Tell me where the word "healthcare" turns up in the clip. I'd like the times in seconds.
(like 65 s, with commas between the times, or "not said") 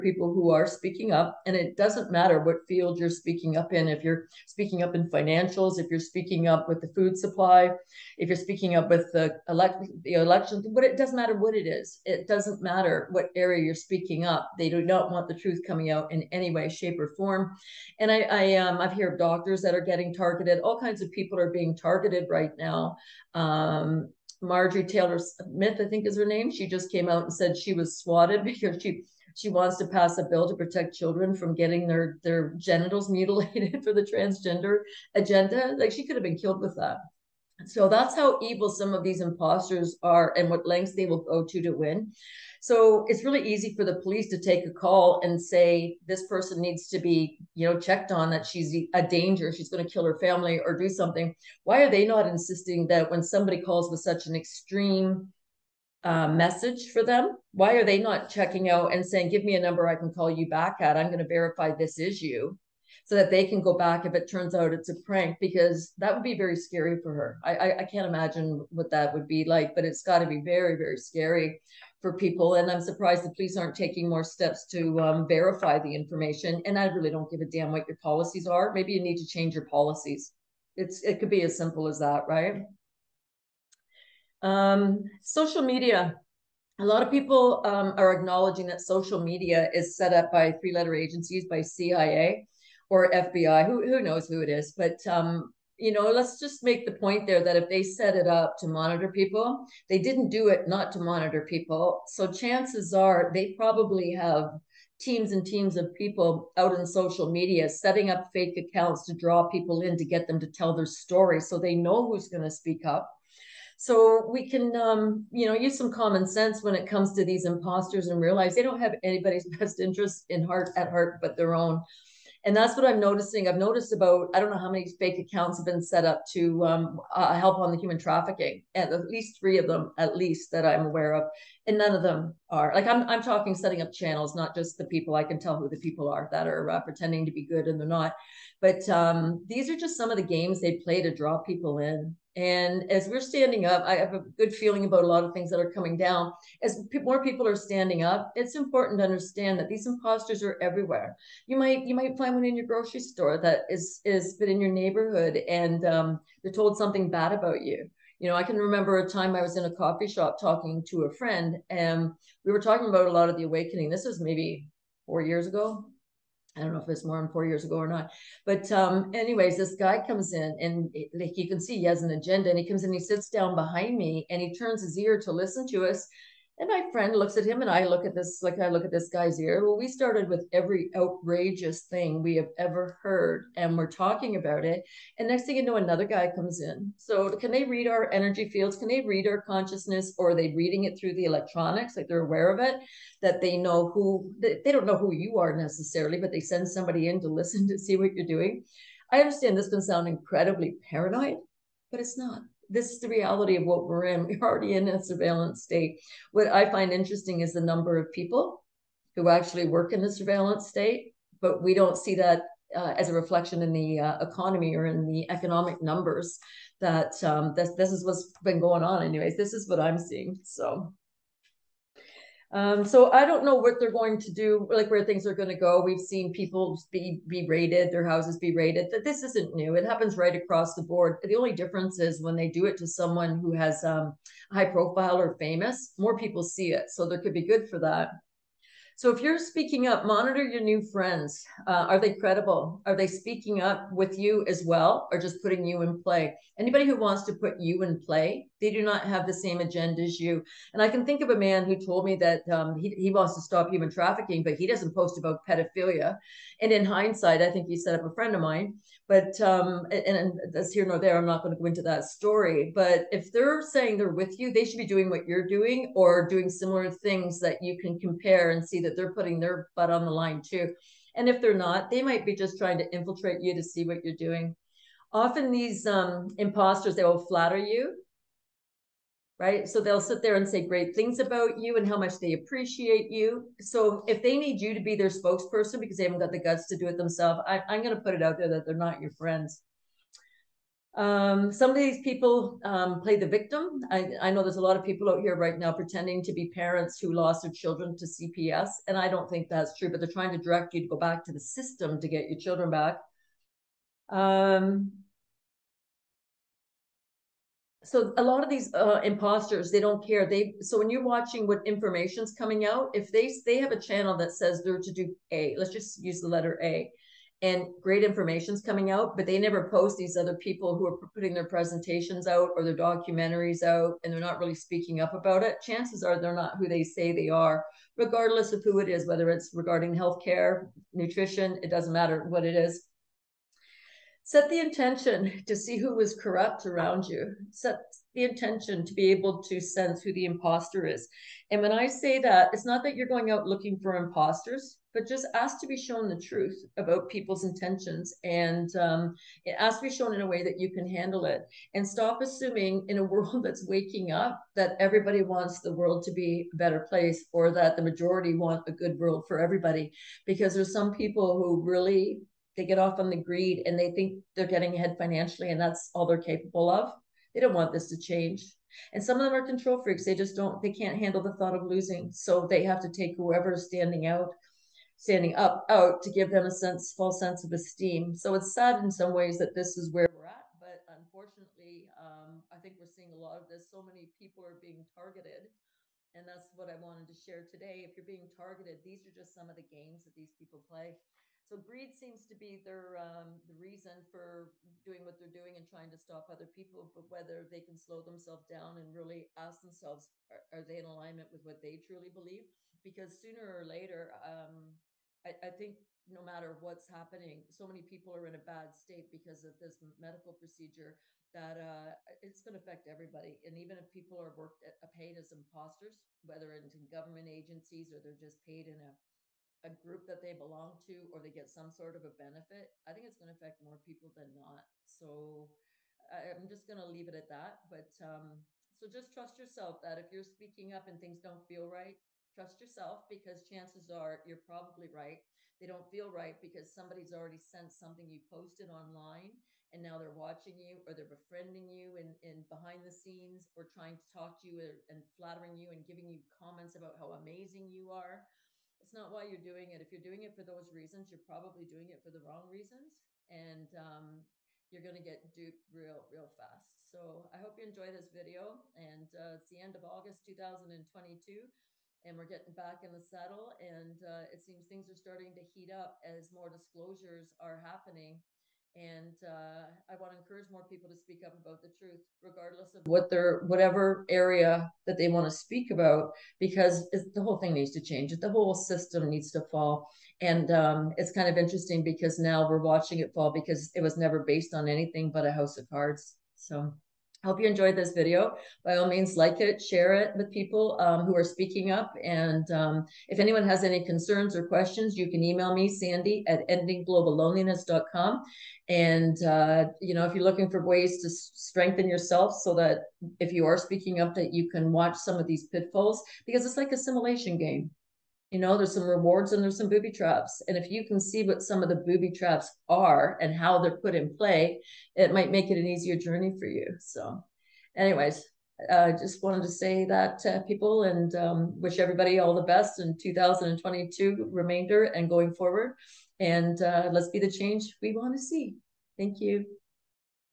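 329 s.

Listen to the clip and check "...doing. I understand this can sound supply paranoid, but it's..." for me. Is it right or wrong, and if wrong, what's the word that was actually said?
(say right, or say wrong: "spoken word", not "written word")
wrong: "incredibly", not "supply".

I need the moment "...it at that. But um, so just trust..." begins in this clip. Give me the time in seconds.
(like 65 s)
427 s.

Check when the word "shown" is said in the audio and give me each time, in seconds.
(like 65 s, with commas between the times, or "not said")
345 s, 349 s.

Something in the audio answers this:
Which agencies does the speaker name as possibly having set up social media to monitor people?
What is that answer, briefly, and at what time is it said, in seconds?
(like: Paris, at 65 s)
CIA or FBI, at 91 s.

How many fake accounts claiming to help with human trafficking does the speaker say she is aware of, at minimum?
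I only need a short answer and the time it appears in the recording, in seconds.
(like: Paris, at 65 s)
3, at 128 s.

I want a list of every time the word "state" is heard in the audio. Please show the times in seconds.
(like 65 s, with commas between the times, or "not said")
205 s, 210 s, 408 s.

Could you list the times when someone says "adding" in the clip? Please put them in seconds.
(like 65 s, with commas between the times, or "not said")
not said.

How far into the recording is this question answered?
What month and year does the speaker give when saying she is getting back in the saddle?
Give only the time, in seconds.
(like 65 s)
459 s.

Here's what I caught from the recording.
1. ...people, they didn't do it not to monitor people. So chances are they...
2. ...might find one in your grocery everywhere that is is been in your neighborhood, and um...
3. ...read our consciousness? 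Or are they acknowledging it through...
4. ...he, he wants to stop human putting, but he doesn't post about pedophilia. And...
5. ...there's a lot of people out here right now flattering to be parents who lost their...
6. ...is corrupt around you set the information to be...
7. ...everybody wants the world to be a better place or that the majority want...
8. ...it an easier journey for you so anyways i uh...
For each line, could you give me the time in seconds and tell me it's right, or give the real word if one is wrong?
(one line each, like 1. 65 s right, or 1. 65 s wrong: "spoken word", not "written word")
1. 99 s right
2. 151 s wrong: "store", not "everywhere"
3. 189 s wrong: "reading", not "acknowledging"
4. 252 s wrong: "trafficking", not "putting"
5. 294 s wrong: "pretending", not "flattering"
6. 336 s wrong: "intention", not "information"
7. 354 s right
8. 515 s right.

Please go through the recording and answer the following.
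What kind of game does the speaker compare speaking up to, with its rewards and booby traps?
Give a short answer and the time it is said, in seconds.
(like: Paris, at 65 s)
simulation game, at 506 s.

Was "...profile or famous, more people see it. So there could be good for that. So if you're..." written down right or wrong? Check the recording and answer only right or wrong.
right.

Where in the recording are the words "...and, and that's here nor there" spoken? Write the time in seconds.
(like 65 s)
259 s.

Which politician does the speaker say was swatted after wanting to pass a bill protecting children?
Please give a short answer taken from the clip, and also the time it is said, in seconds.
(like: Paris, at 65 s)
Marjorie Taylor Smith, at 24 s.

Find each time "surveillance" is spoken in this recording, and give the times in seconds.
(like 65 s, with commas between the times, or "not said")
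205 s, 210 s.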